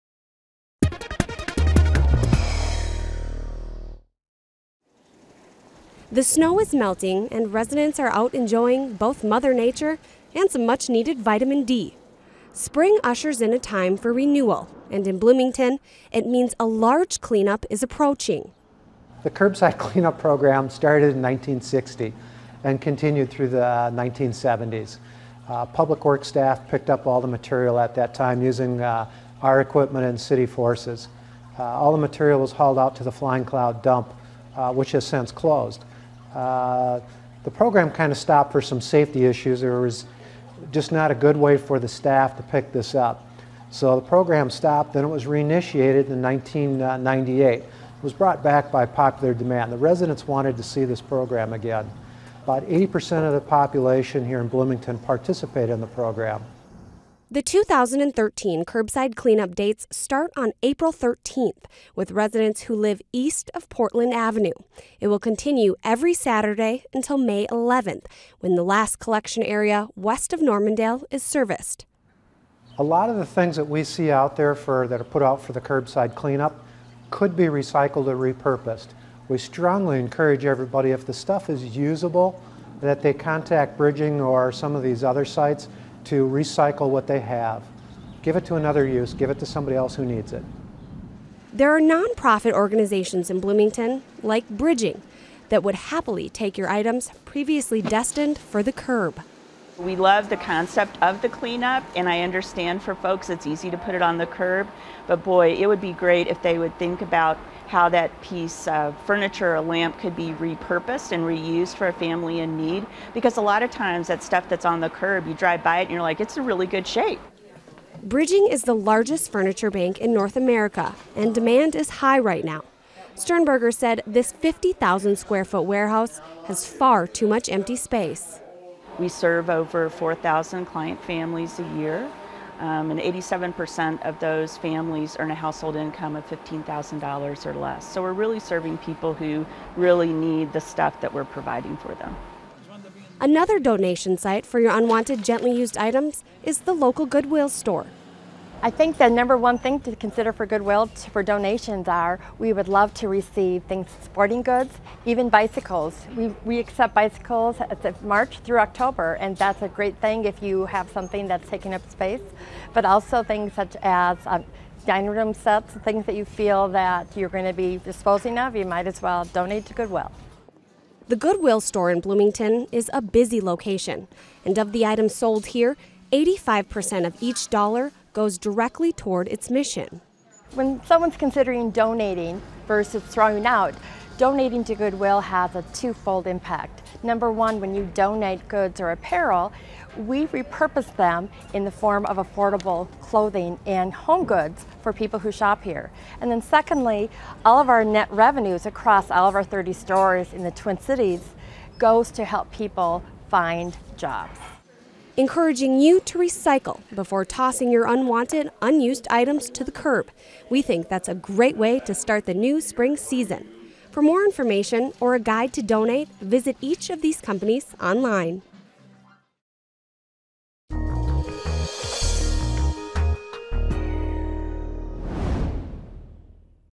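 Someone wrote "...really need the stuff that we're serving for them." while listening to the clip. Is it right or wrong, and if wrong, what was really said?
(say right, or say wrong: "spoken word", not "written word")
wrong: "providing", not "serving".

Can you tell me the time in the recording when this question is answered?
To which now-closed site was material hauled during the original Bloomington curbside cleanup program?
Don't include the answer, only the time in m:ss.
0:33.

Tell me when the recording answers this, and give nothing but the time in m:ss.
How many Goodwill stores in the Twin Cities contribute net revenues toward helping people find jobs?
3:19.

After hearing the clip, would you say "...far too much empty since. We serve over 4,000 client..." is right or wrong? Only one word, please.
wrong.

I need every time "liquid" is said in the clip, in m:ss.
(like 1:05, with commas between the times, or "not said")
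not said.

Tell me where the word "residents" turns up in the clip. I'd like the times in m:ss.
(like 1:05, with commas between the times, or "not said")
0:07, 0:49, 1:02.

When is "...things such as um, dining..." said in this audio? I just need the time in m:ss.
2:43.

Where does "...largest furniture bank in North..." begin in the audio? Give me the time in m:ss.
1:58.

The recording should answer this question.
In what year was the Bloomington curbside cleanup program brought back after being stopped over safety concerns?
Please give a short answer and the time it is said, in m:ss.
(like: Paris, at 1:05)
1998, at 0:46.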